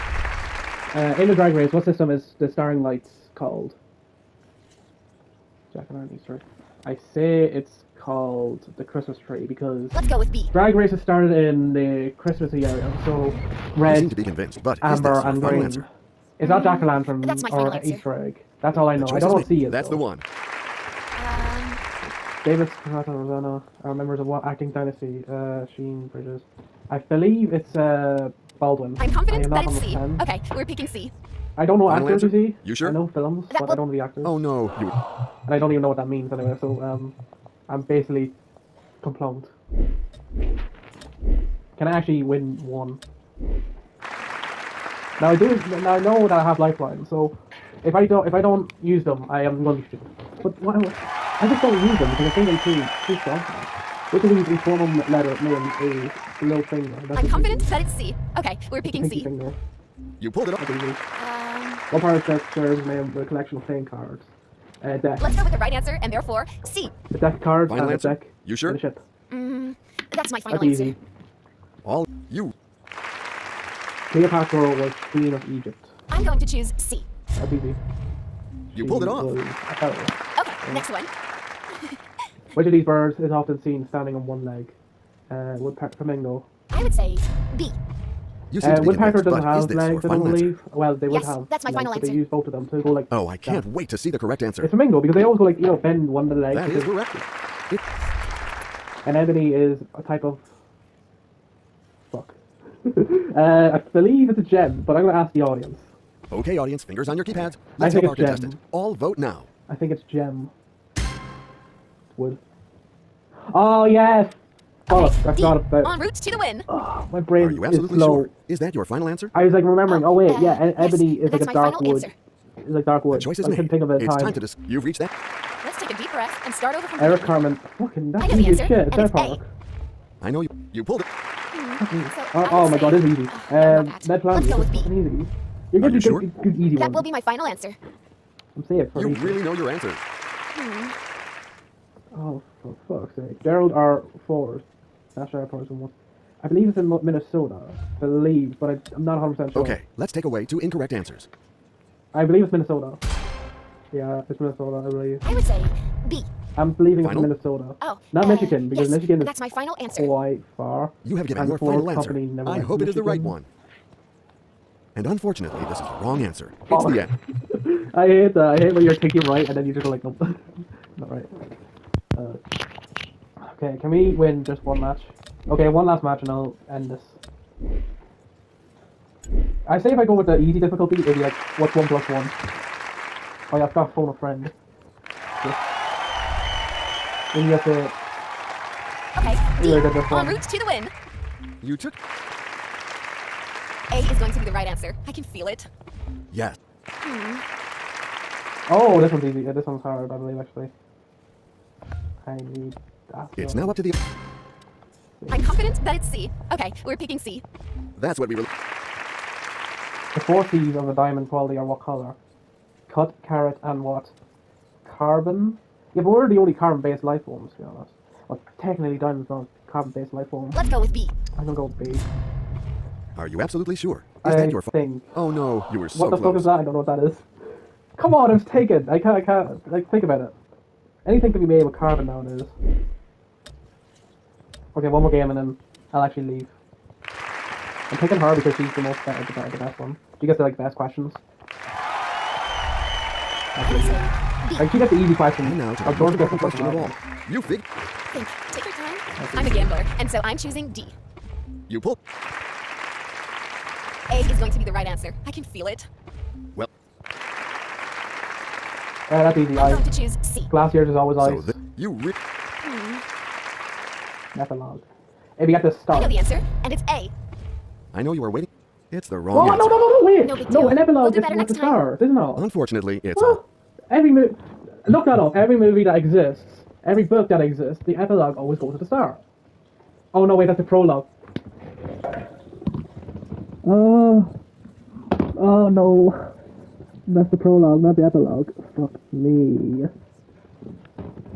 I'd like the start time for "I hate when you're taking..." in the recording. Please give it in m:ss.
2:48.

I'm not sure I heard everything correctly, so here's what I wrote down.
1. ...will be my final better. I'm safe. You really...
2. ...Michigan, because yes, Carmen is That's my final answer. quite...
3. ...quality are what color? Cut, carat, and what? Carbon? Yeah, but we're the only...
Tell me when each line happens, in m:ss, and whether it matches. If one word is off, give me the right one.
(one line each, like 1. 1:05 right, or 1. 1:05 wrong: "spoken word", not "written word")
1. 2:16 wrong: "answer", not "better"
2. 2:38 wrong: "Michigan", not "Carmen"
3. 3:31 right.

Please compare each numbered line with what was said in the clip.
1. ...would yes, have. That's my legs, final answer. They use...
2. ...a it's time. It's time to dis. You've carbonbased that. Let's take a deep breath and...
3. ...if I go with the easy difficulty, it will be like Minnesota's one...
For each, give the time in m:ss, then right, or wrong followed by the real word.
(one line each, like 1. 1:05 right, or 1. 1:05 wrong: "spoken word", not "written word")
1. 1:31 right
2. 2:03 wrong: "reached", not "carbonbased"
3. 2:59 wrong: "What", not "Minnesota".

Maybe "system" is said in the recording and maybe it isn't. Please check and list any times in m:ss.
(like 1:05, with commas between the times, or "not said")
0:01.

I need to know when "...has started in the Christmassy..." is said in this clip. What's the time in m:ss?
0:10.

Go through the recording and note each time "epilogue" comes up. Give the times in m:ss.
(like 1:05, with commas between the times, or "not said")
4:30, 4:37, 4:48.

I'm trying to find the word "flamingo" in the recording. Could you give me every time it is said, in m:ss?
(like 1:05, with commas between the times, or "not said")
1:25, 1:34.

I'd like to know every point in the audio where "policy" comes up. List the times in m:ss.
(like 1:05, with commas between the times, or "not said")
not said.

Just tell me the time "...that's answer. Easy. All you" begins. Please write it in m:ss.
1:10.